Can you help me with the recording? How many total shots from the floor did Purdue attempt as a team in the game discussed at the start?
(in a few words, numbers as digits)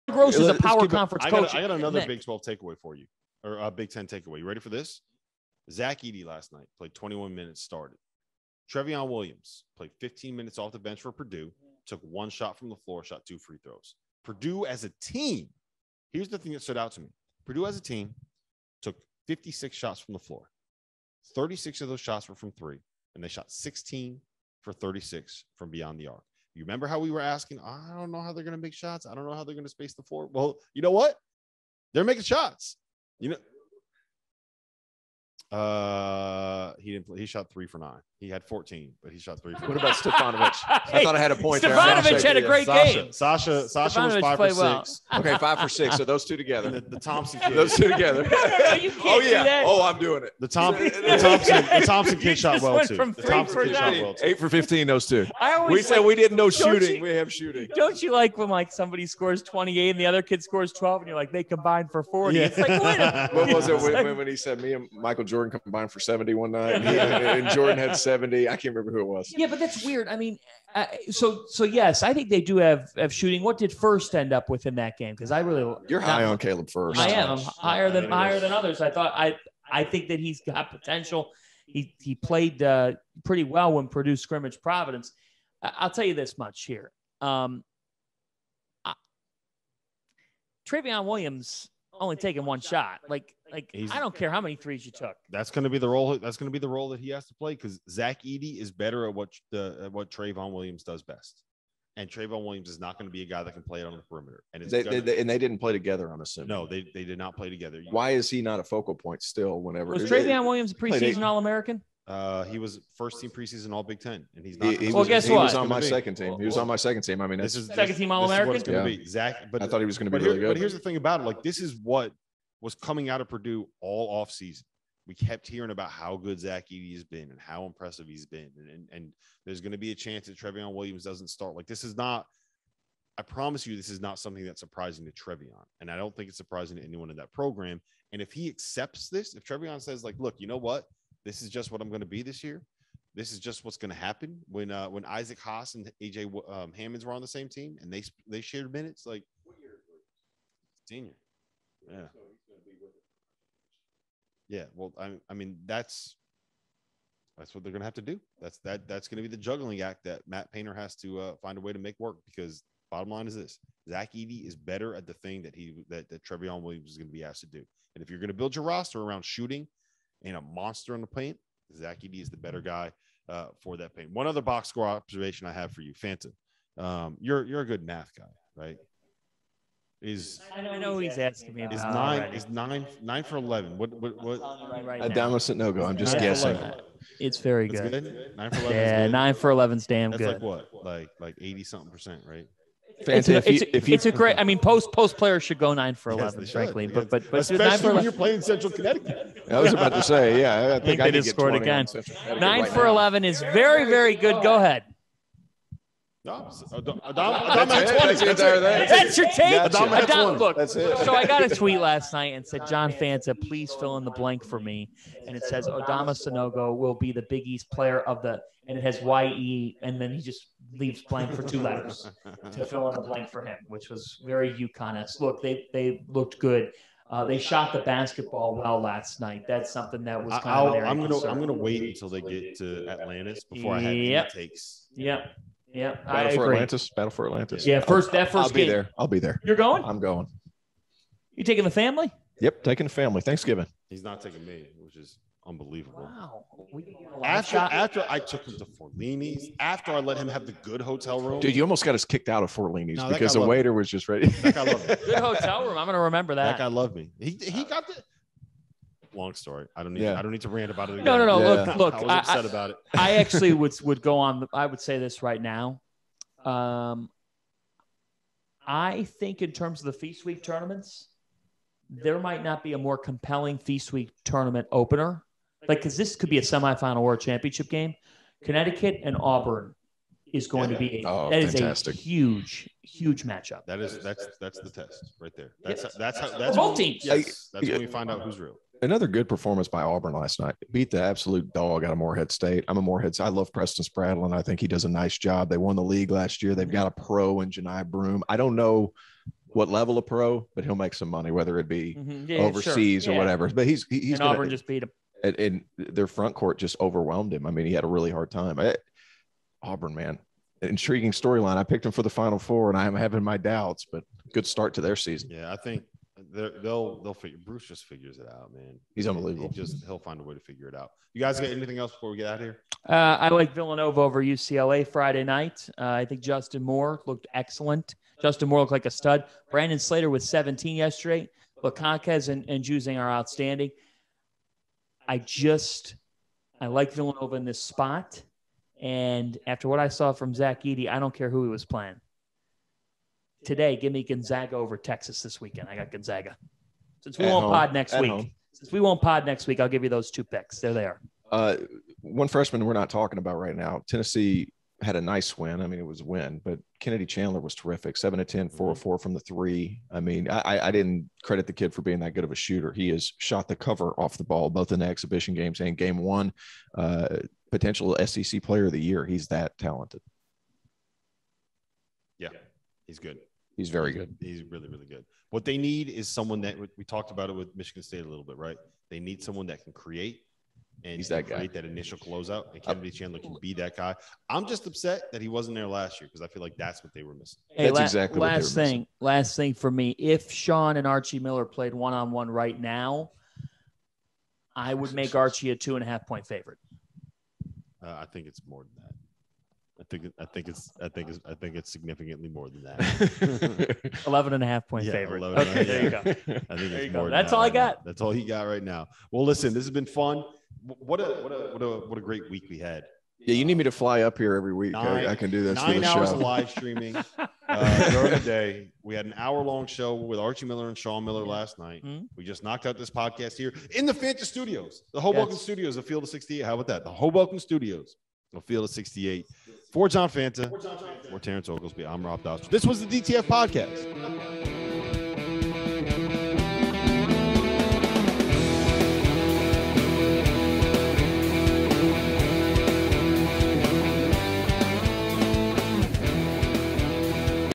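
56.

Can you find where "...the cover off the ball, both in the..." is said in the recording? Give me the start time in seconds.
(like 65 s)
363 s.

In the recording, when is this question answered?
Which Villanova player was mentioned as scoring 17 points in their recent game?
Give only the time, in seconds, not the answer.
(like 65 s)
329 s.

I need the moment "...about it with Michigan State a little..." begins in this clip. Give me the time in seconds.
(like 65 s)
377 s.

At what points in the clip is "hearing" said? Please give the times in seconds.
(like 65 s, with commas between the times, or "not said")
125 s.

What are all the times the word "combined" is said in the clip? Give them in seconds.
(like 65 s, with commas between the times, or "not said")
61 s, 65 s.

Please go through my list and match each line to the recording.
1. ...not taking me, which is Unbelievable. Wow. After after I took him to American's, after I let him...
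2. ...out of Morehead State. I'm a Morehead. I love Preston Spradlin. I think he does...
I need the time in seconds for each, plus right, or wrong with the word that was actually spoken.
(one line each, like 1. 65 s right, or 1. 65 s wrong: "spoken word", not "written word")
1. 244 s wrong: "Forlini", not "American"
2. 291 s right.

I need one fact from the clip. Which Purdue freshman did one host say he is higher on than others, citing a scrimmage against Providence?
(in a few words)
Caleb Furst.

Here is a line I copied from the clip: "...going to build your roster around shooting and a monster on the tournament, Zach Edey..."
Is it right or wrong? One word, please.
wrong.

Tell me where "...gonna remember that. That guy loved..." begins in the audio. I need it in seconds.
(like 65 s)
255 s.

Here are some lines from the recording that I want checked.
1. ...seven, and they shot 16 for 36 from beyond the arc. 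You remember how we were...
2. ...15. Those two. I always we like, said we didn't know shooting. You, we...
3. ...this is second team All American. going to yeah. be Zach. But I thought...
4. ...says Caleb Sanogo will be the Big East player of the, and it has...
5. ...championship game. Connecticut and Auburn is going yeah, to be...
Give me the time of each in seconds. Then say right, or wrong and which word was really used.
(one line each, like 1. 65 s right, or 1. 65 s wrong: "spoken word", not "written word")
1. 22 s wrong: "three", not "seven"
2. 54 s right
3. 117 s right
4. 215 s wrong: "Adama", not "Caleb"
5. 277 s right.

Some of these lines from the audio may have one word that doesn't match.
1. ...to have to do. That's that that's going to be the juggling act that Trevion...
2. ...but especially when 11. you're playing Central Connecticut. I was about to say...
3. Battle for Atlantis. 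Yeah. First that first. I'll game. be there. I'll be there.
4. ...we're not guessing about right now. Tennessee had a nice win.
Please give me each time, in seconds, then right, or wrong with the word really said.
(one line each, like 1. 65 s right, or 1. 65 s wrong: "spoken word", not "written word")
1. 157 s wrong: "Matt", not "Trevion"
2. 197 s right
3. 236 s right
4. 352 s wrong: "talking", not "guessing".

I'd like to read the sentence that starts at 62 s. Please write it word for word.
It's like what was it when, when he said me and Michael Jordan?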